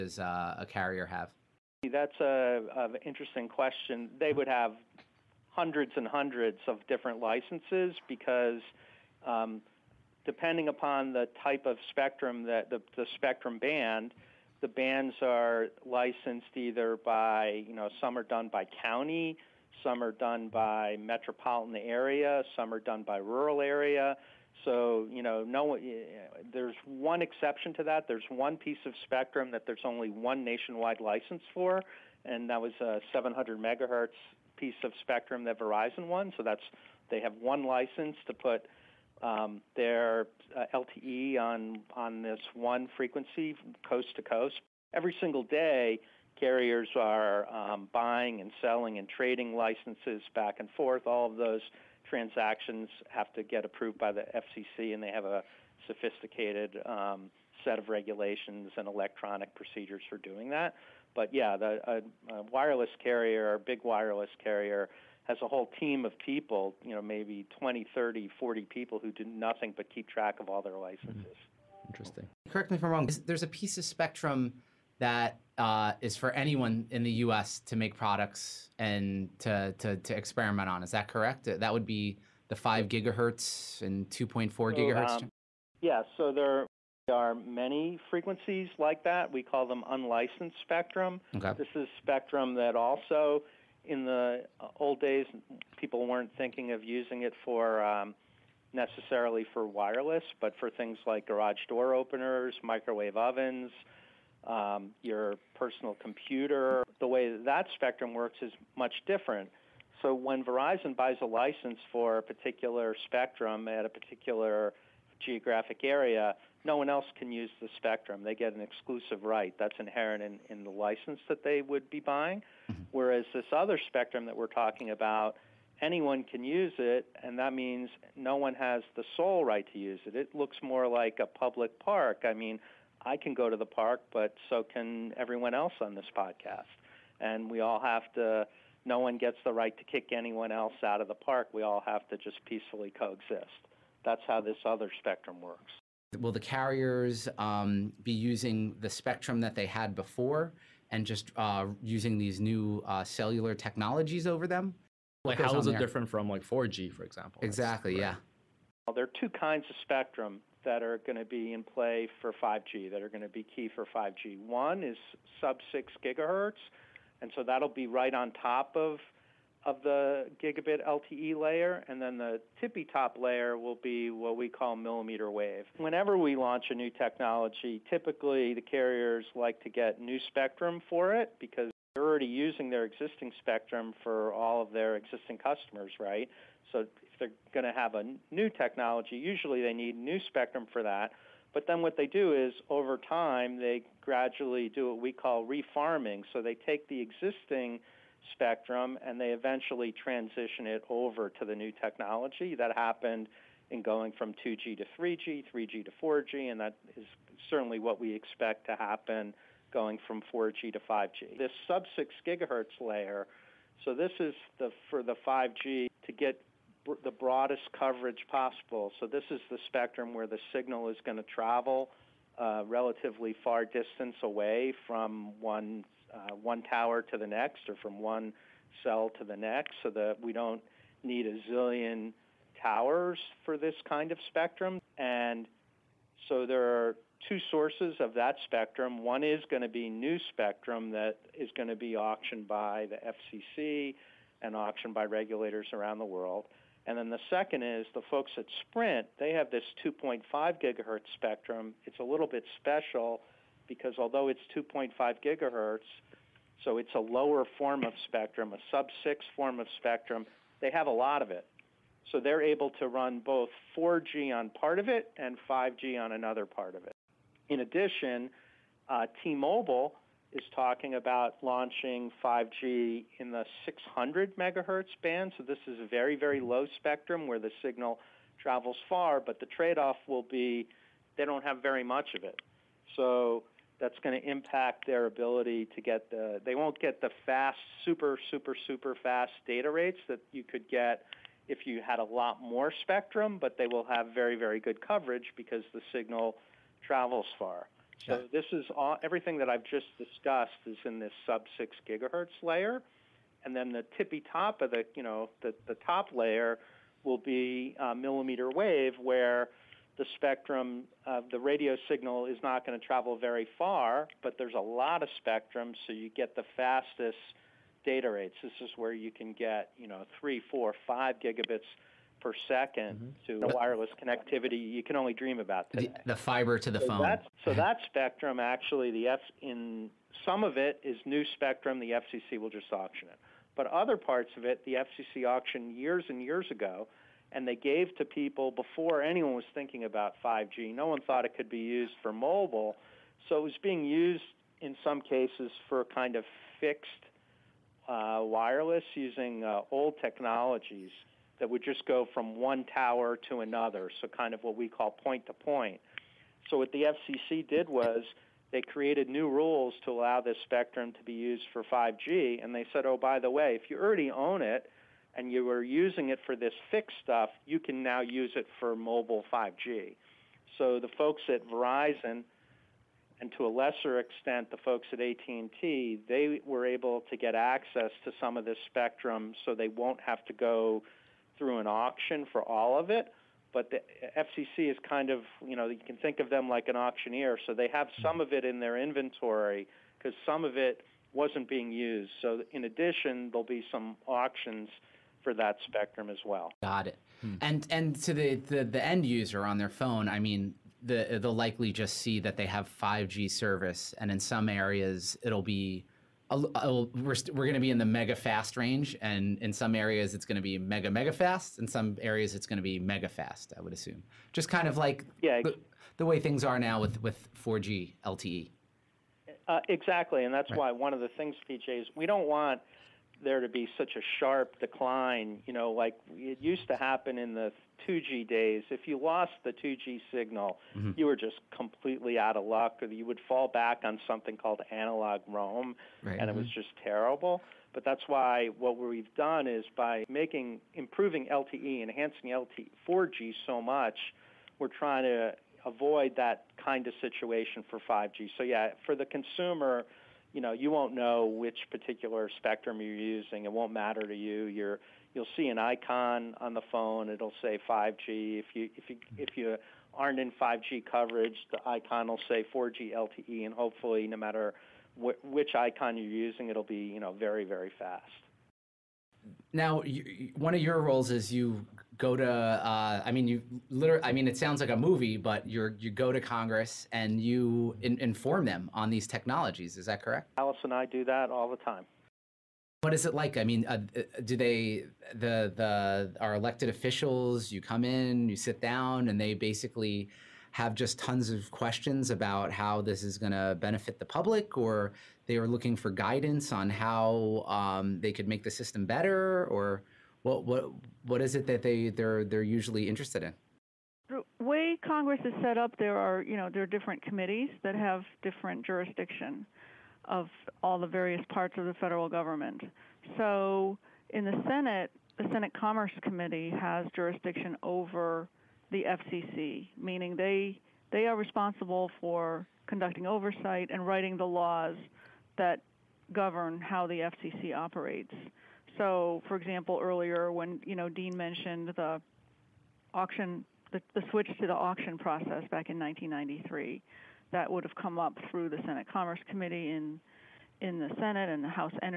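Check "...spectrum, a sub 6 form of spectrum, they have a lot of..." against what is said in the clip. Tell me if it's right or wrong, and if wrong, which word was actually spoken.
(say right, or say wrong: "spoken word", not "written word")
right.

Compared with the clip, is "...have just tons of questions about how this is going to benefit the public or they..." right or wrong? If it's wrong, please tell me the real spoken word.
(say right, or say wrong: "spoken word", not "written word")
right.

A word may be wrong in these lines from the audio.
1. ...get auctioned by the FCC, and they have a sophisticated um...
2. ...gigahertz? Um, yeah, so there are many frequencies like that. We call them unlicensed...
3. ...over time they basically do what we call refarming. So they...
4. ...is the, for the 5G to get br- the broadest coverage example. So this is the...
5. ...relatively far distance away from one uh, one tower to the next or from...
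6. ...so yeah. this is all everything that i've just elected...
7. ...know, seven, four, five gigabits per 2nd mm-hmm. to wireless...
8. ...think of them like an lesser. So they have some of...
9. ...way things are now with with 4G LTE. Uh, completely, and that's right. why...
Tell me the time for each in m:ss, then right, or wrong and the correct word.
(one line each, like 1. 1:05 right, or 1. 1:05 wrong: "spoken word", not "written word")
1. 0:53 wrong: "approved", not "auctioned"
2. 1:24 right
3. 3:12 wrong: "gradually", not "basically"
4. 3:34 wrong: "possible", not "example"
5. 3:42 right
6. 4:58 wrong: "discussed", not "elected"
7. 5:19 wrong: "three", not "seven"
8. 6:25 wrong: "auctioneer", not "lesser"
9. 6:56 wrong: "exactly", not "completely".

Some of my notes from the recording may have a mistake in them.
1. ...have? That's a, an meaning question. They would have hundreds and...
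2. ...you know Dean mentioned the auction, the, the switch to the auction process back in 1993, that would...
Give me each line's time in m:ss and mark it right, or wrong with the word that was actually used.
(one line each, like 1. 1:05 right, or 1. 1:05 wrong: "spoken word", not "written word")
1. 0:01 wrong: "interesting", not "meaning"
2. 8:50 right.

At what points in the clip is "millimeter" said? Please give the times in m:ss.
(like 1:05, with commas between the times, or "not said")
2:54, 5:07.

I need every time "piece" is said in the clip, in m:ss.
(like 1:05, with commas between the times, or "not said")
0:28, 0:34, 1:13.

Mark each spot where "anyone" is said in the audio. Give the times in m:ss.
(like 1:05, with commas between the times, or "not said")
1:16, 2:05, 2:20, 5:39.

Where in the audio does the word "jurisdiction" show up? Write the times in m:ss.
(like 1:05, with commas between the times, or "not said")
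8:28, 8:36.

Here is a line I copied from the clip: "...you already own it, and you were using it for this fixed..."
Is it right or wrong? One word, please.
right.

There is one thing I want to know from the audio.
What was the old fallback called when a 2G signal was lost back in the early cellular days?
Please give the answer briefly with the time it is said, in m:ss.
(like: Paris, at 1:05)
analog roam, at 7:14.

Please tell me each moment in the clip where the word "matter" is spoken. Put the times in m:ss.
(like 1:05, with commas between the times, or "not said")
7:33, 7:44.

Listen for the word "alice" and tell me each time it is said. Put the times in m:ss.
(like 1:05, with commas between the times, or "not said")
8:00.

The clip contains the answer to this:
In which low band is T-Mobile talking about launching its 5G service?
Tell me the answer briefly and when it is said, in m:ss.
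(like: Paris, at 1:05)
600 megahertz, at 4:33.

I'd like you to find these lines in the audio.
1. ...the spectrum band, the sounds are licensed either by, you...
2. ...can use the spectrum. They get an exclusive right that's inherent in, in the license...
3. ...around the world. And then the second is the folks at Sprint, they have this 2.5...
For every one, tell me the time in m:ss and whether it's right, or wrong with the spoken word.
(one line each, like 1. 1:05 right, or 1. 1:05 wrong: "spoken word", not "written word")
1. 0:12 wrong: "bands", not "sounds"
2. 1:57 right
3. 4:05 right.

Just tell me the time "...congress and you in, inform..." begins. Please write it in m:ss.
7:56.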